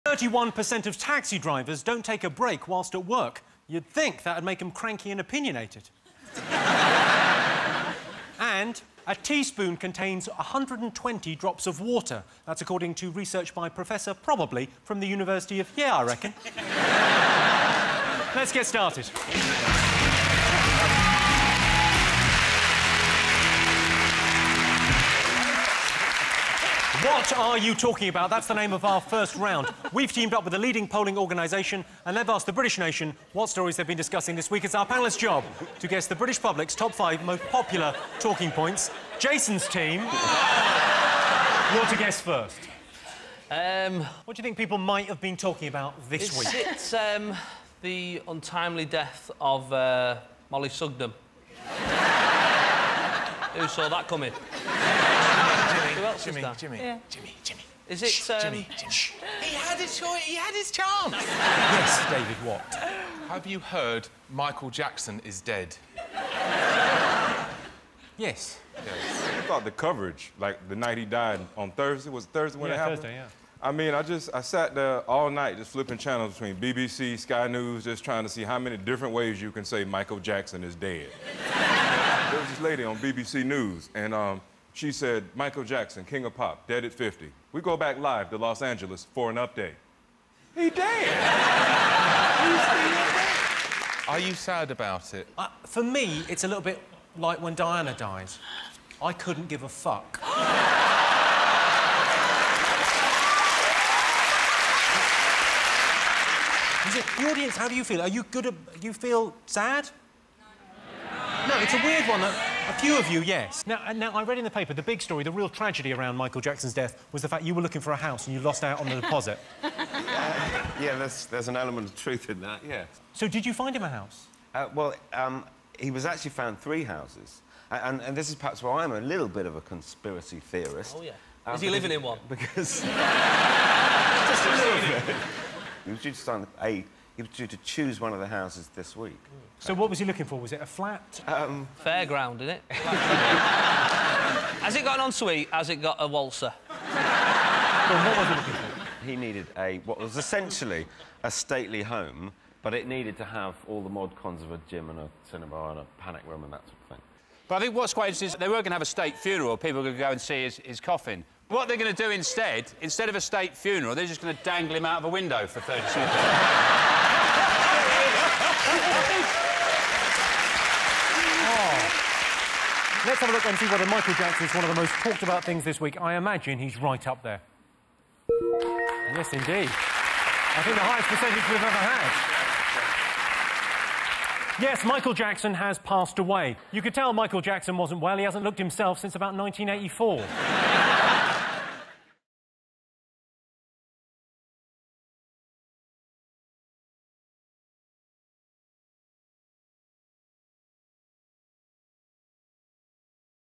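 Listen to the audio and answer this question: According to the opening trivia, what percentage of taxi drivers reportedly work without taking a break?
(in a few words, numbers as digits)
31%.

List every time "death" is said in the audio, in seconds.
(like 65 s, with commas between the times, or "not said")
48 s, 116 s.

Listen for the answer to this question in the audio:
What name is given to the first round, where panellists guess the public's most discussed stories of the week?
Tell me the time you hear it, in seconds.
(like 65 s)
27 s.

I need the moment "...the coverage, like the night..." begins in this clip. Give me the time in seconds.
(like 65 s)
69 s.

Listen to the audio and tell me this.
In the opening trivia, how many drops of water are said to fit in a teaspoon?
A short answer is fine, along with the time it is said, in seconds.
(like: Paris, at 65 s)
120, at 10 s.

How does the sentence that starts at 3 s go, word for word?
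You'd think that'd make them cranky and opinionated.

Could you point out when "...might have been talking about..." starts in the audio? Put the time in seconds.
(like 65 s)
44 s.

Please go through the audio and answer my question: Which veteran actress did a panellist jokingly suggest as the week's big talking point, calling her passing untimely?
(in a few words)
Mollie Sugden.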